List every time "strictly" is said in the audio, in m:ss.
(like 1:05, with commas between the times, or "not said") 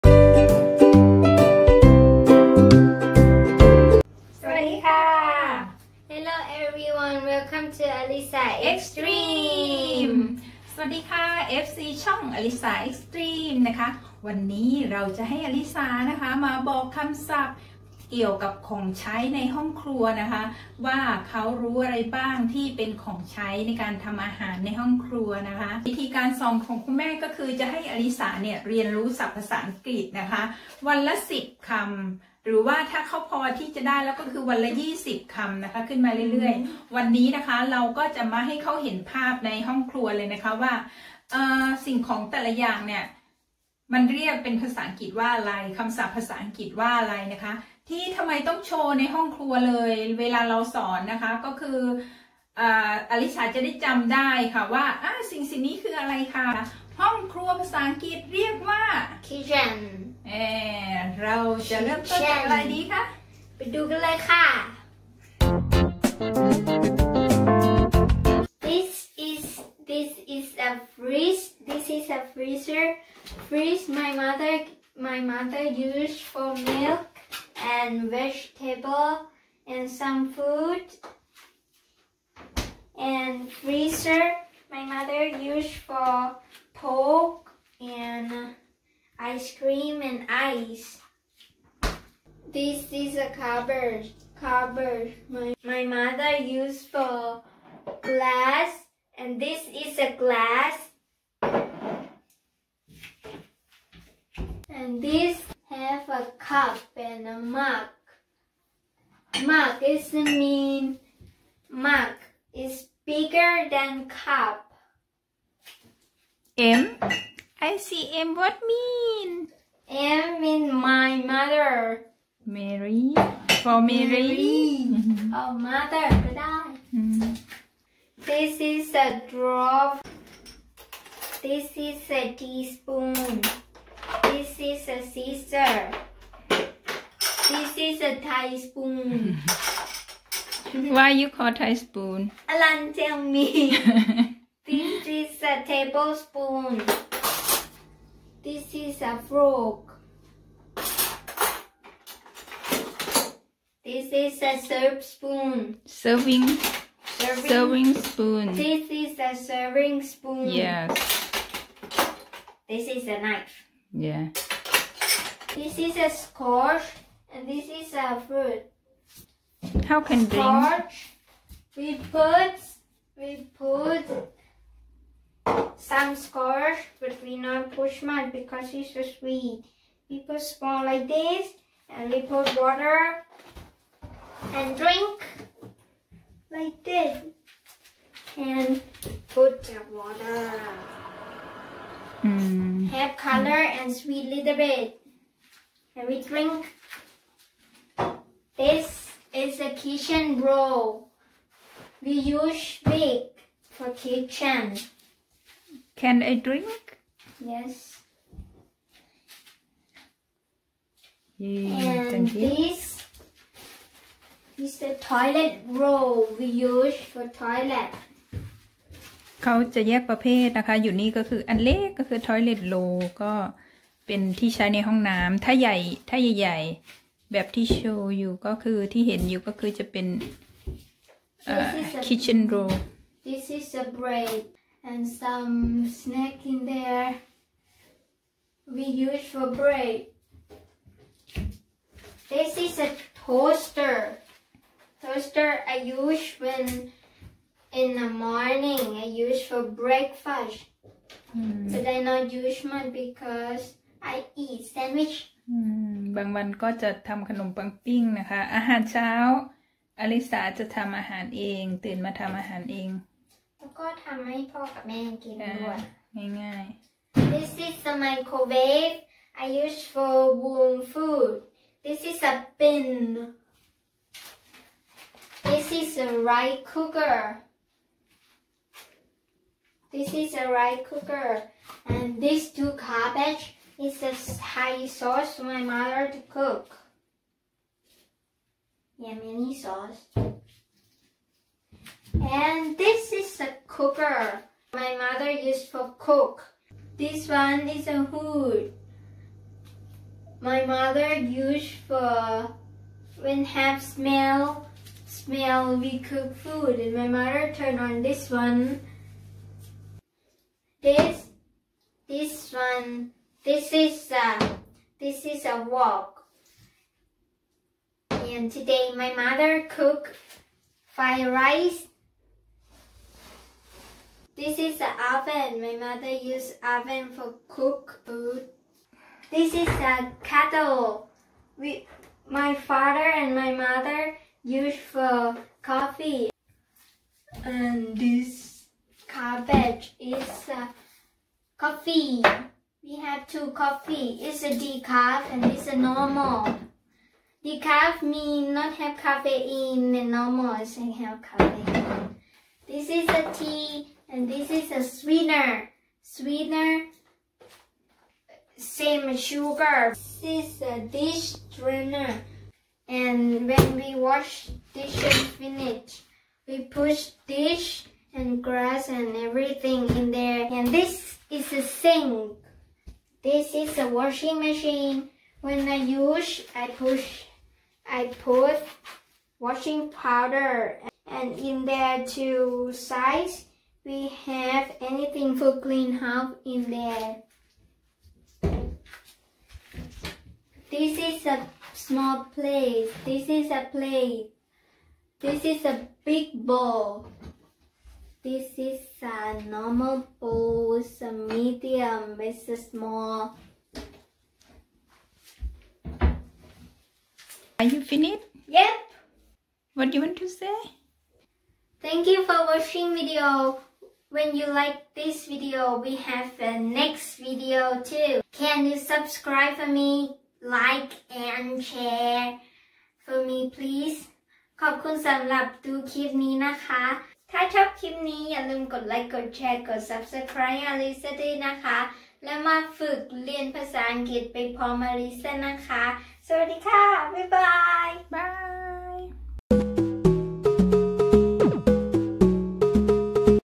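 not said.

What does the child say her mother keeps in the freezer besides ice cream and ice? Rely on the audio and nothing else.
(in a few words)
pork.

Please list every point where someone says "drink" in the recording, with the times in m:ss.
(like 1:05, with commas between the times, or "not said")
3:04, 3:16, 3:26.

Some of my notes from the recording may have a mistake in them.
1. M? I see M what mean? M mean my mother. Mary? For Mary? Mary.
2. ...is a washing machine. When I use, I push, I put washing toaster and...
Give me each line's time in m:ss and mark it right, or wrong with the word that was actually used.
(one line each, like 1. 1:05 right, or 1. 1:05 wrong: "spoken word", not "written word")
1. 1:56 right
2. 6:13 wrong: "powder", not "toaster".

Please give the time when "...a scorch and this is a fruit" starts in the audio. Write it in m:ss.
2:45.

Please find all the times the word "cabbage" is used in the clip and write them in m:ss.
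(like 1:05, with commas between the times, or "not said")
4:42, 5:39.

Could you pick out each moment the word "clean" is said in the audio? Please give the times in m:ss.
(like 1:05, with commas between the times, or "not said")
6:25.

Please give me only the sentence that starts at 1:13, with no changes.
Freeze my mother my mother used for milk and vegetable and some food.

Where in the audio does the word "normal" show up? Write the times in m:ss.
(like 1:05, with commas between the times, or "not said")
5:45, 5:50, 6:39.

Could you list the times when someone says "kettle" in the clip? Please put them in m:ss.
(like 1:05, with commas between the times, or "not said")
5:30.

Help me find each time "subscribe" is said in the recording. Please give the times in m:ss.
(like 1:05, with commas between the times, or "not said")
6:58, 7:09.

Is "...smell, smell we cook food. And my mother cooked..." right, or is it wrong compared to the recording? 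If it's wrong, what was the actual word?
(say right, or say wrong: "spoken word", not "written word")
wrong: "turned", not "cooked".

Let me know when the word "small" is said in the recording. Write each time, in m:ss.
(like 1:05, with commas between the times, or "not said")
3:00, 6:31, 6:42.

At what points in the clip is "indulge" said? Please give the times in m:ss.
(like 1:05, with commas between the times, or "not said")
not said.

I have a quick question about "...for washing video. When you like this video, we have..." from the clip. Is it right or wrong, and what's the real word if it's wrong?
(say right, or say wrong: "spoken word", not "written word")
wrong: "watching", not "washing".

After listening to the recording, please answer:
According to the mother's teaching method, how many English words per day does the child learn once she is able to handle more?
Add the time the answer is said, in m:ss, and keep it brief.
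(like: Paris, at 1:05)
20, at 0:35.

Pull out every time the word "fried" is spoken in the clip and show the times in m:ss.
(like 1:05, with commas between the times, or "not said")
5:20.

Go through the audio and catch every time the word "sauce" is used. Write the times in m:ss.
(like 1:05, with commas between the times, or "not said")
4:44, 4:49.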